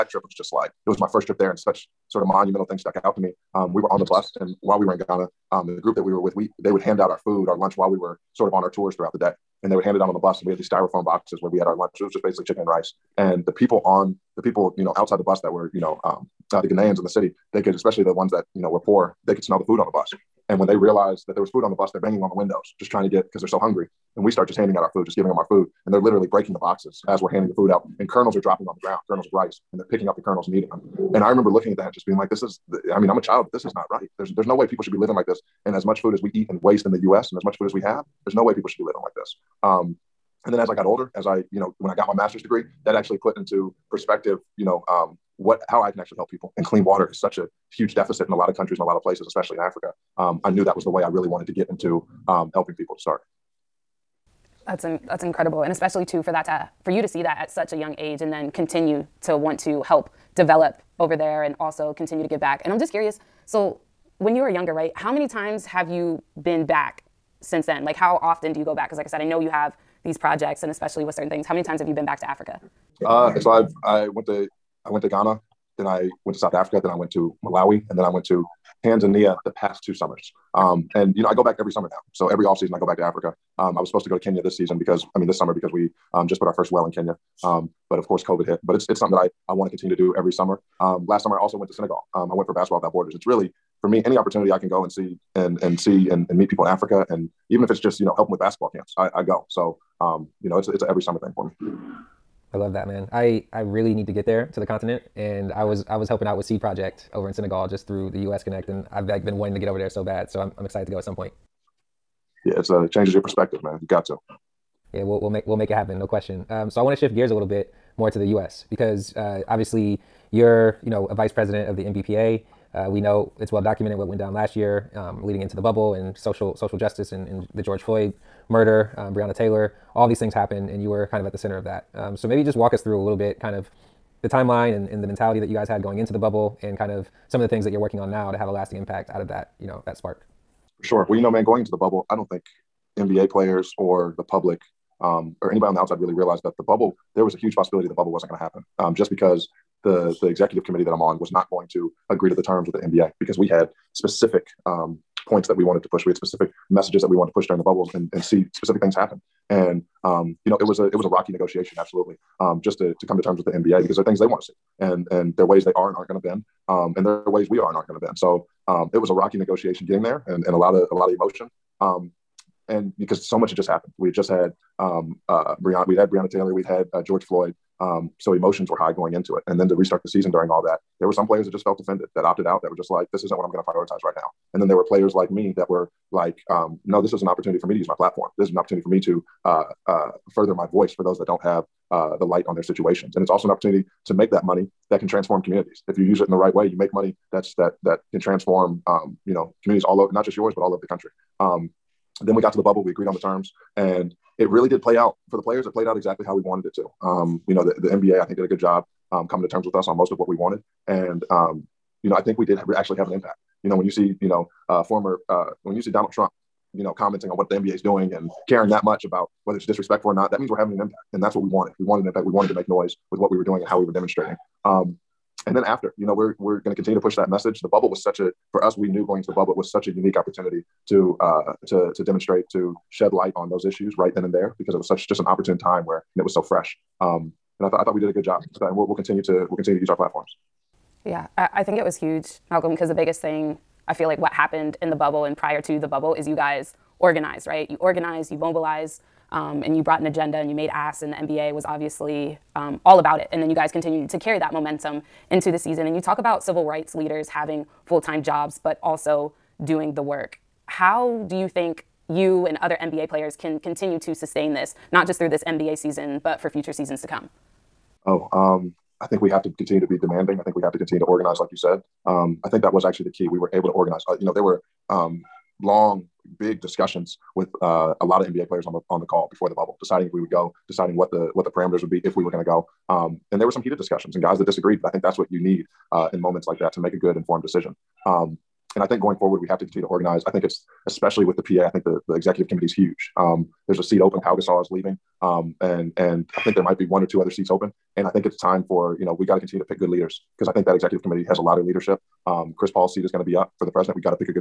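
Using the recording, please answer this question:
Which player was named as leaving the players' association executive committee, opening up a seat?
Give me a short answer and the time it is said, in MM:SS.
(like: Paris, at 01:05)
Pau Gasol, at 04:54.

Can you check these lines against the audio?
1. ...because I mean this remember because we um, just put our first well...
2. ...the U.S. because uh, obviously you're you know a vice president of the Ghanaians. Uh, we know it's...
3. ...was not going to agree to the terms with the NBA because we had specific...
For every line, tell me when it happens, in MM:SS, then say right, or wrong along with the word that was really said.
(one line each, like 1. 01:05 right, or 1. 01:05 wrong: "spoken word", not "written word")
1. 01:24 wrong: "summer", not "remember"
2. 01:58 wrong: "NBPA", not "Ghanaians"
3. 02:31 right.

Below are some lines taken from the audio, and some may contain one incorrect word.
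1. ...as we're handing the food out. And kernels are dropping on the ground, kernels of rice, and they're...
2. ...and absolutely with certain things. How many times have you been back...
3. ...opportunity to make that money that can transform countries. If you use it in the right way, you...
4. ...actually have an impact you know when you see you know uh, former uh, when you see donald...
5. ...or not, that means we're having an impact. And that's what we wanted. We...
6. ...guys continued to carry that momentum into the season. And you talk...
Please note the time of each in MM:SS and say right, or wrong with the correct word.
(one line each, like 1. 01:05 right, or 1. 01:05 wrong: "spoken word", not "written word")
1. 00:27 right
2. 01:10 wrong: "especially", not "absolutely"
3. 03:13 wrong: "communities", not "countries"
4. 03:32 right
5. 03:40 right
6. 04:13 right.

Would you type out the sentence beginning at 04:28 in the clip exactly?
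Oh, um, I think we have to continue to be demanding.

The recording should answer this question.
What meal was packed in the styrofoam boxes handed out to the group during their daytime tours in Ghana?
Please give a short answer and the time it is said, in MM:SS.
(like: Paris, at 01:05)
Chicken and rice, at 00:12.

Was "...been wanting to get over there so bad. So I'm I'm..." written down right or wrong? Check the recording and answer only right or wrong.
right.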